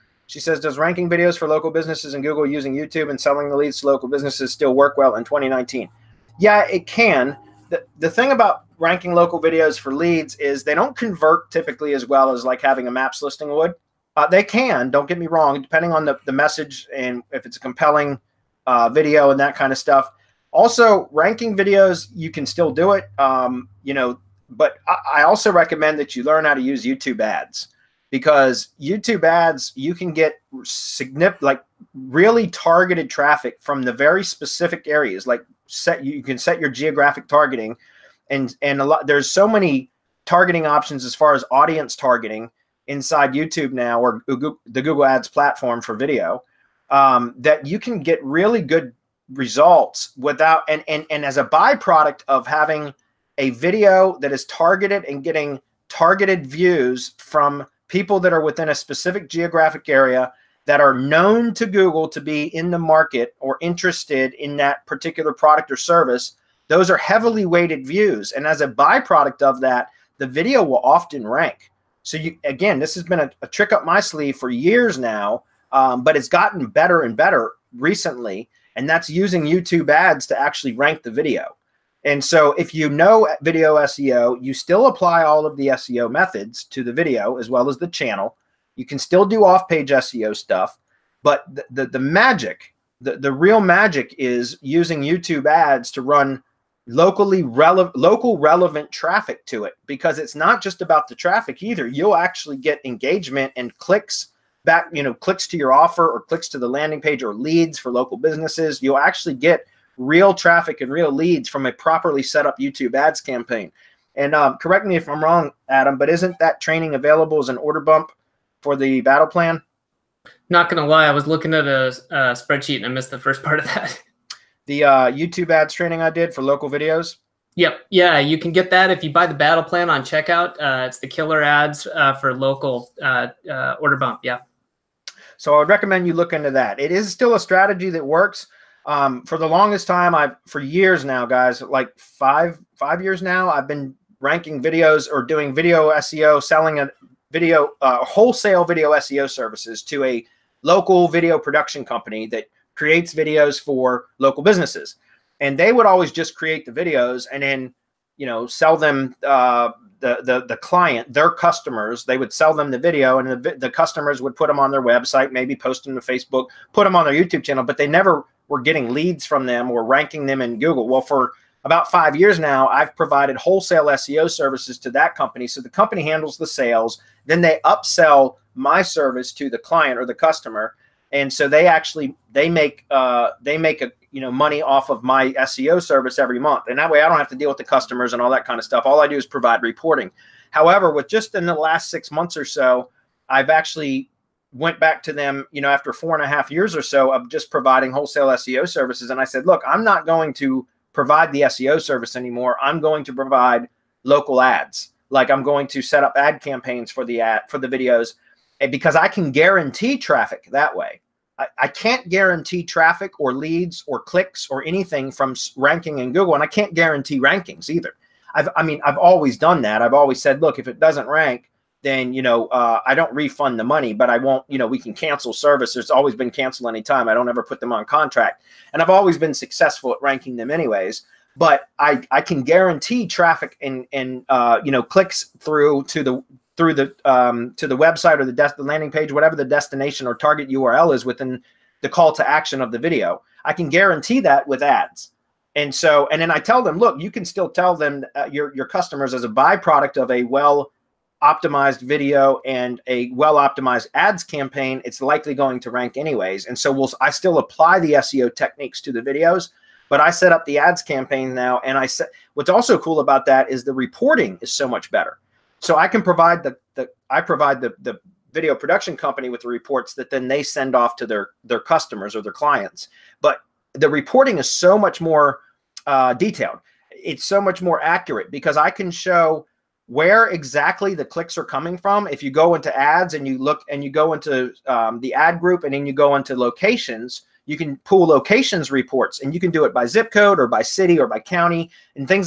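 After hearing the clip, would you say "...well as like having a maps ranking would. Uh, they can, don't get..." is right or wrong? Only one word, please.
wrong.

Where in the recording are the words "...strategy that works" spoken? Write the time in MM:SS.
02:17.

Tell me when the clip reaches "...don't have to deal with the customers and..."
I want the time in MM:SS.
03:07.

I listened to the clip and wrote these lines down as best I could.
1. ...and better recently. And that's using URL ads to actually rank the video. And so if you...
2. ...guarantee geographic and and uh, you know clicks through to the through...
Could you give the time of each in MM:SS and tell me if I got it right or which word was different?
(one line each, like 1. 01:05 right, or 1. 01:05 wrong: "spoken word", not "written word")
1. 01:17 wrong: "YouTube", not "URL"
2. 03:52 wrong: "traffic", not "geographic".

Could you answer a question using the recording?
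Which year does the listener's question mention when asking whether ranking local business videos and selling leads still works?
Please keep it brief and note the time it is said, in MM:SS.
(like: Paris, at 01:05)
2019, at 00:05.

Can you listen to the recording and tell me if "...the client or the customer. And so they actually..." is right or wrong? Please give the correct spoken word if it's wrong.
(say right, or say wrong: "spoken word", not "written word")
right.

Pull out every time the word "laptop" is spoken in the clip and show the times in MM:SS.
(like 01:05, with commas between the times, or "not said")
not said.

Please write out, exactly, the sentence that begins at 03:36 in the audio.
And I can't guarantee rankings either.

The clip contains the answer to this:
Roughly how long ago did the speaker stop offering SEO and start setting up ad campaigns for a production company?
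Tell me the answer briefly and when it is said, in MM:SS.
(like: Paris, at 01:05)
Last six months, at 03:11.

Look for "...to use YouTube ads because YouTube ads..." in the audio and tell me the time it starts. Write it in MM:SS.
00:26.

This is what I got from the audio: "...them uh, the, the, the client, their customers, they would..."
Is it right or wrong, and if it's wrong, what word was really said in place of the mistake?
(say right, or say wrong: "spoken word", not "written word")
right.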